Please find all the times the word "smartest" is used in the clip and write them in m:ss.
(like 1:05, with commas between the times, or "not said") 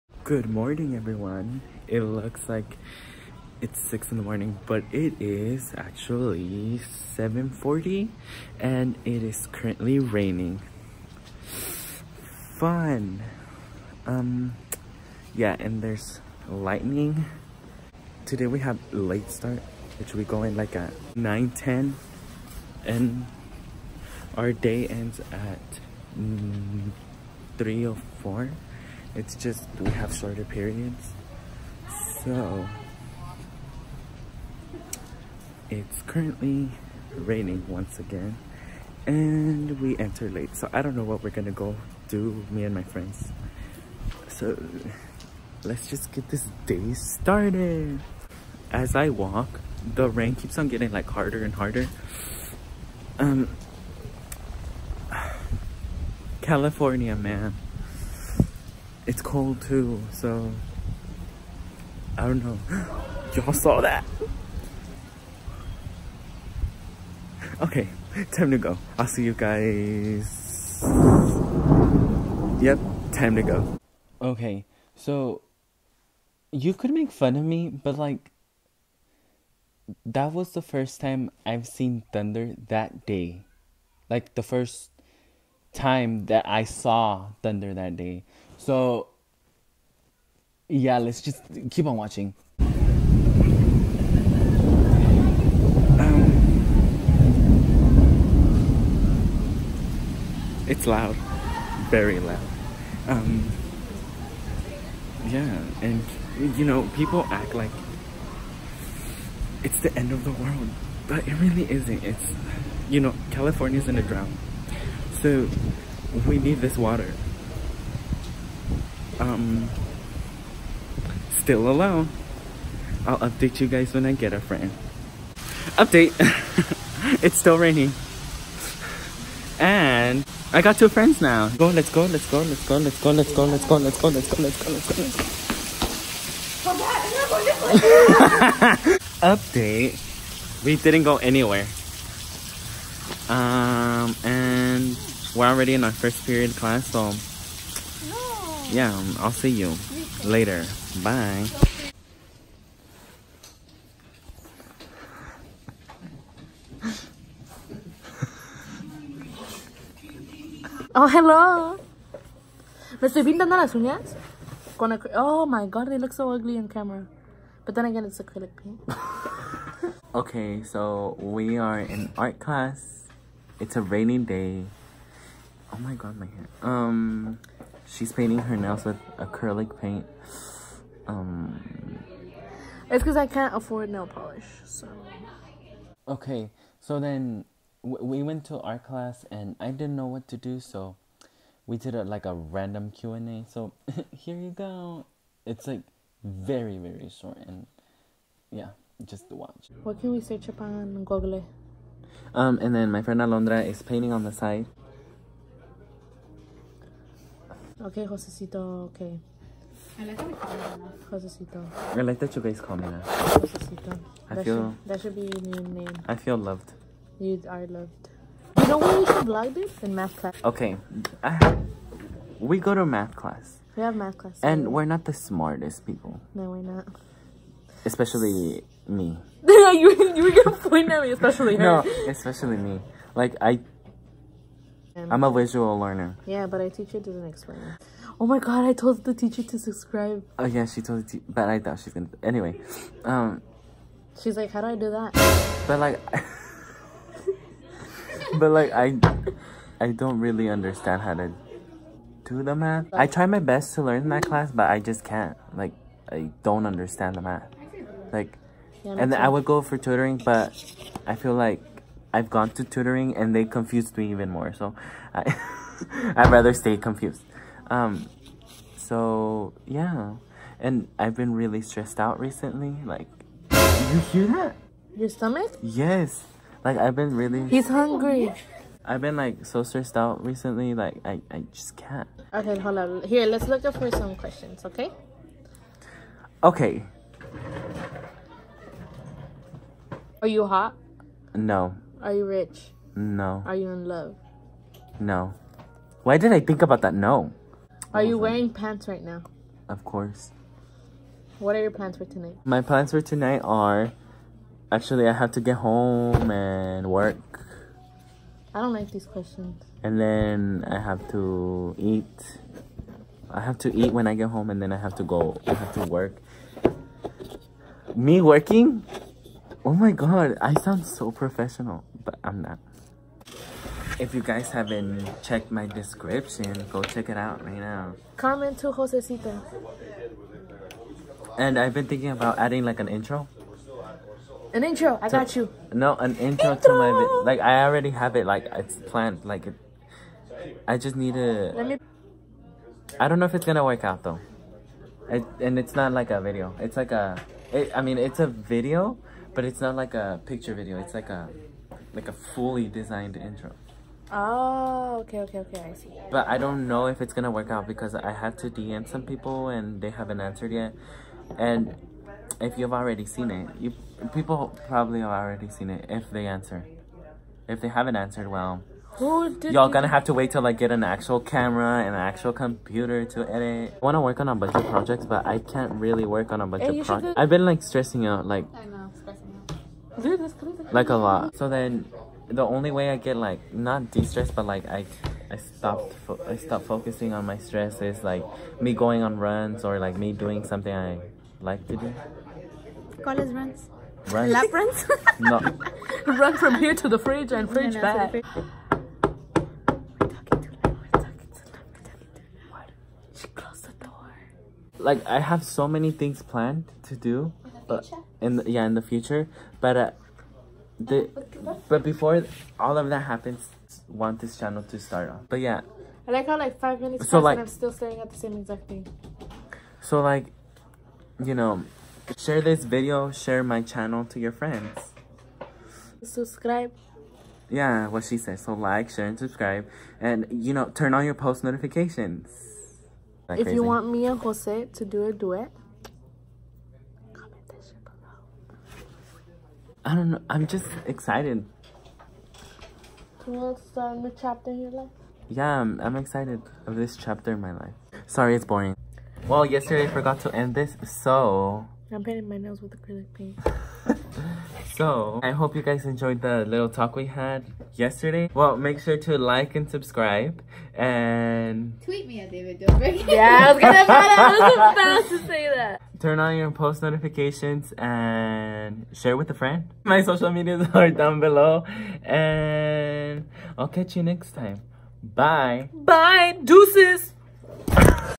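3:45.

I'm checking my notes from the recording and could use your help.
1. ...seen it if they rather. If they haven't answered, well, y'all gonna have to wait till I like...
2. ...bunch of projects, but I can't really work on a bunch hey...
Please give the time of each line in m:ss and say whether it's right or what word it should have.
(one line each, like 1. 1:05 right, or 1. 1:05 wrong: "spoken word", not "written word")
1. 6:05 wrong: "answer", not "rather"
2. 6:14 right.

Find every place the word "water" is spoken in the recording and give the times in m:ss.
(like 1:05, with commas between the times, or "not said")
1:56.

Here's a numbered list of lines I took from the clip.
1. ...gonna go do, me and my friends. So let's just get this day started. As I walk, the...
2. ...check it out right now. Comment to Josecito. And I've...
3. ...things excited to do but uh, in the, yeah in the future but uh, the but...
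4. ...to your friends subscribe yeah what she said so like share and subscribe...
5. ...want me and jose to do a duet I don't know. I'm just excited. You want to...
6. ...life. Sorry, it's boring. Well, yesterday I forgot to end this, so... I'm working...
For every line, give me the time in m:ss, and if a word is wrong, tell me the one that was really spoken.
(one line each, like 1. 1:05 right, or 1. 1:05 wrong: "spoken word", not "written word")
1. 0:41 right
2. 5:26 right
3. 6:45 wrong: "planned", not "excited"
4. 7:04 right
5. 7:13 right
6. 7:27 wrong: "painting", not "working".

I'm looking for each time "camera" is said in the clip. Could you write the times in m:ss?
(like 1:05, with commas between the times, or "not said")
2:46, 6:11.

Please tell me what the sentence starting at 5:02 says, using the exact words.
My plans for tonight are actually I have to get home and work.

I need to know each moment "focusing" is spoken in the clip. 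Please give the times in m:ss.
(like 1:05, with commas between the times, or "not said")
6:26.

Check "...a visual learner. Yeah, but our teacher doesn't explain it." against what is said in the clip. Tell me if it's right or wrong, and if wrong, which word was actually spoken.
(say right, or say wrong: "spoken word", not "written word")
right.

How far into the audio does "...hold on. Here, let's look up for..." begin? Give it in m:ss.
4:42.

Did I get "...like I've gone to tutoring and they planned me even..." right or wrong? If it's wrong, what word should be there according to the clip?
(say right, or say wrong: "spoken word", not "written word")
wrong: "confused", not "planned".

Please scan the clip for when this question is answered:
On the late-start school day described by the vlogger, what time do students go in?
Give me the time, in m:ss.
0:21.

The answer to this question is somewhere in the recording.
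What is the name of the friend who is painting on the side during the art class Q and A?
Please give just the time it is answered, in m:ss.
3:23.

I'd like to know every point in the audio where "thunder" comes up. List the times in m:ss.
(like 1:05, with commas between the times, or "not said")
1:22, 1:27.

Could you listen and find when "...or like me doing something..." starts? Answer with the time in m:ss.
6:29.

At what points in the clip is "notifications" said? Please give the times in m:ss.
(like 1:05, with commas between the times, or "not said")
7:11, 7:46.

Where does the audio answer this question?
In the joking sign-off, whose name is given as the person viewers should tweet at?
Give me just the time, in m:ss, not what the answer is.
7:42.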